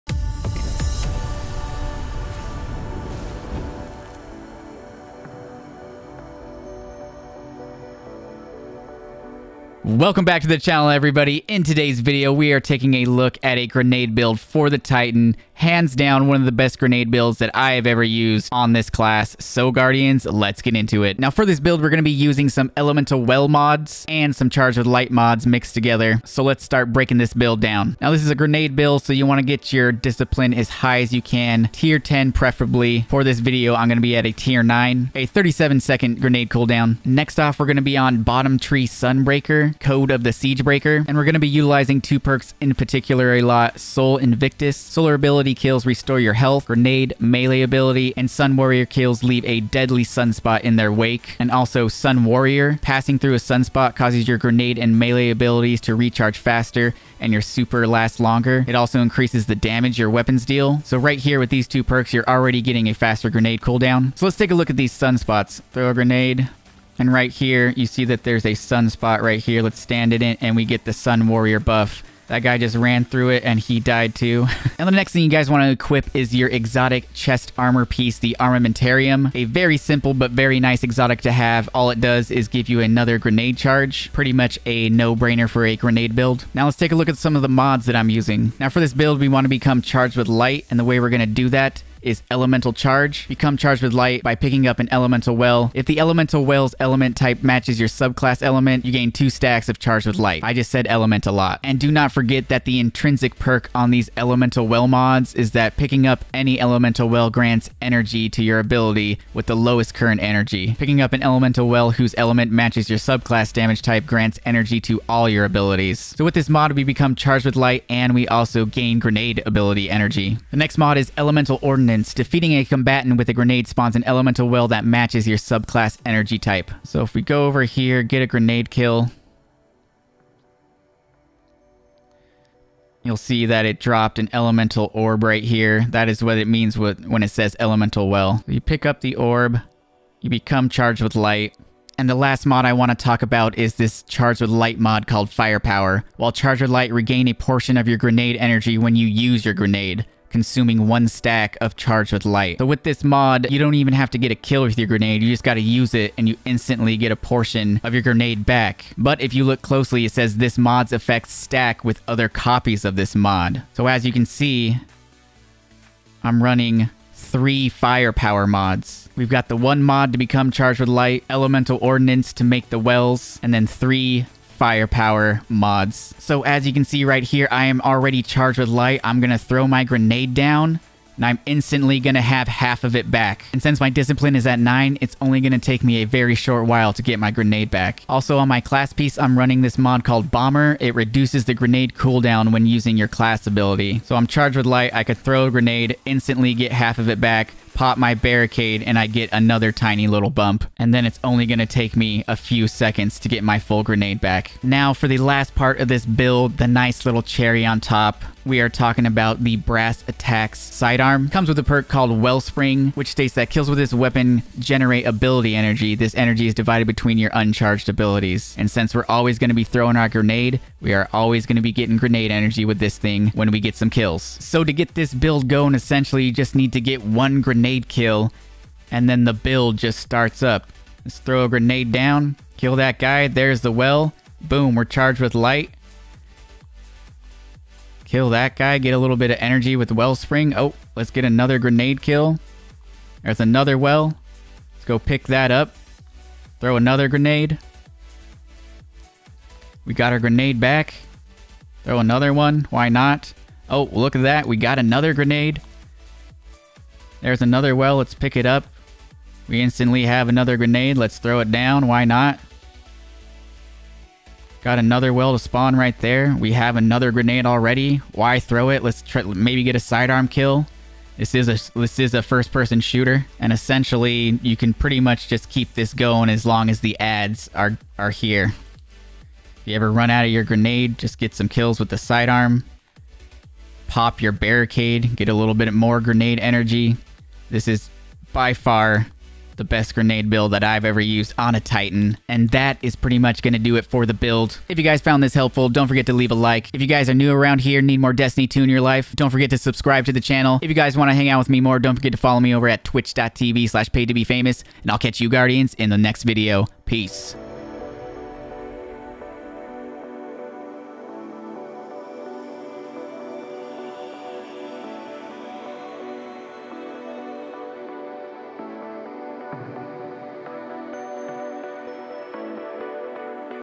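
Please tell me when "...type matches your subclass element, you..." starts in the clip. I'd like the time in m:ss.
1:37.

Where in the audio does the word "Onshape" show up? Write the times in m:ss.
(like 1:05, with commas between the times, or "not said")
not said.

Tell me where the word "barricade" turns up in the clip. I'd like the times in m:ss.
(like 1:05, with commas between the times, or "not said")
3:18, 4:44.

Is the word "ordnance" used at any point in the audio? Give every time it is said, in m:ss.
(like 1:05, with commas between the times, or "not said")
2:01, 2:51.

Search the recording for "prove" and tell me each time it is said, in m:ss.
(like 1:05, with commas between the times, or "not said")
not said.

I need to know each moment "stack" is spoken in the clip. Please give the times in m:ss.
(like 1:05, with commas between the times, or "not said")
1:39, 2:31, 2:41.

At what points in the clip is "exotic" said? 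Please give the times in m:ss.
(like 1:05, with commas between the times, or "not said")
1:16, 1:20.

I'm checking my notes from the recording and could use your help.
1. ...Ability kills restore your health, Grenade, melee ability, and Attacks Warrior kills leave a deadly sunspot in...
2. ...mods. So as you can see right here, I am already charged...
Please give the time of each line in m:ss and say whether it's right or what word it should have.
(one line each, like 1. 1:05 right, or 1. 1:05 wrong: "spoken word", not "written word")
1. 0:45 wrong: "Sun", not "Attacks"
2. 2:55 right.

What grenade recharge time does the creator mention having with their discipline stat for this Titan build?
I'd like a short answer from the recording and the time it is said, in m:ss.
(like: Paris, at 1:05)
37 seconds, at 0:35.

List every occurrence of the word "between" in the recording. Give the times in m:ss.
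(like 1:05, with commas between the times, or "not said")
3:36.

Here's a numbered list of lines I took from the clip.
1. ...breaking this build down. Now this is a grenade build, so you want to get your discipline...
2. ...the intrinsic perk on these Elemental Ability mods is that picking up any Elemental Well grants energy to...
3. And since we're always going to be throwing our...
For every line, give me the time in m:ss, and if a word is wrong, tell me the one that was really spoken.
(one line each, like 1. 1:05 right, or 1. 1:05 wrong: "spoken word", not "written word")
1. 0:26 right
2. 1:42 wrong: "Well", not "Ability"
3. 3:38 right.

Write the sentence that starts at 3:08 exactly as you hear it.
Also on my class piece, I'm running this mod called Bomber.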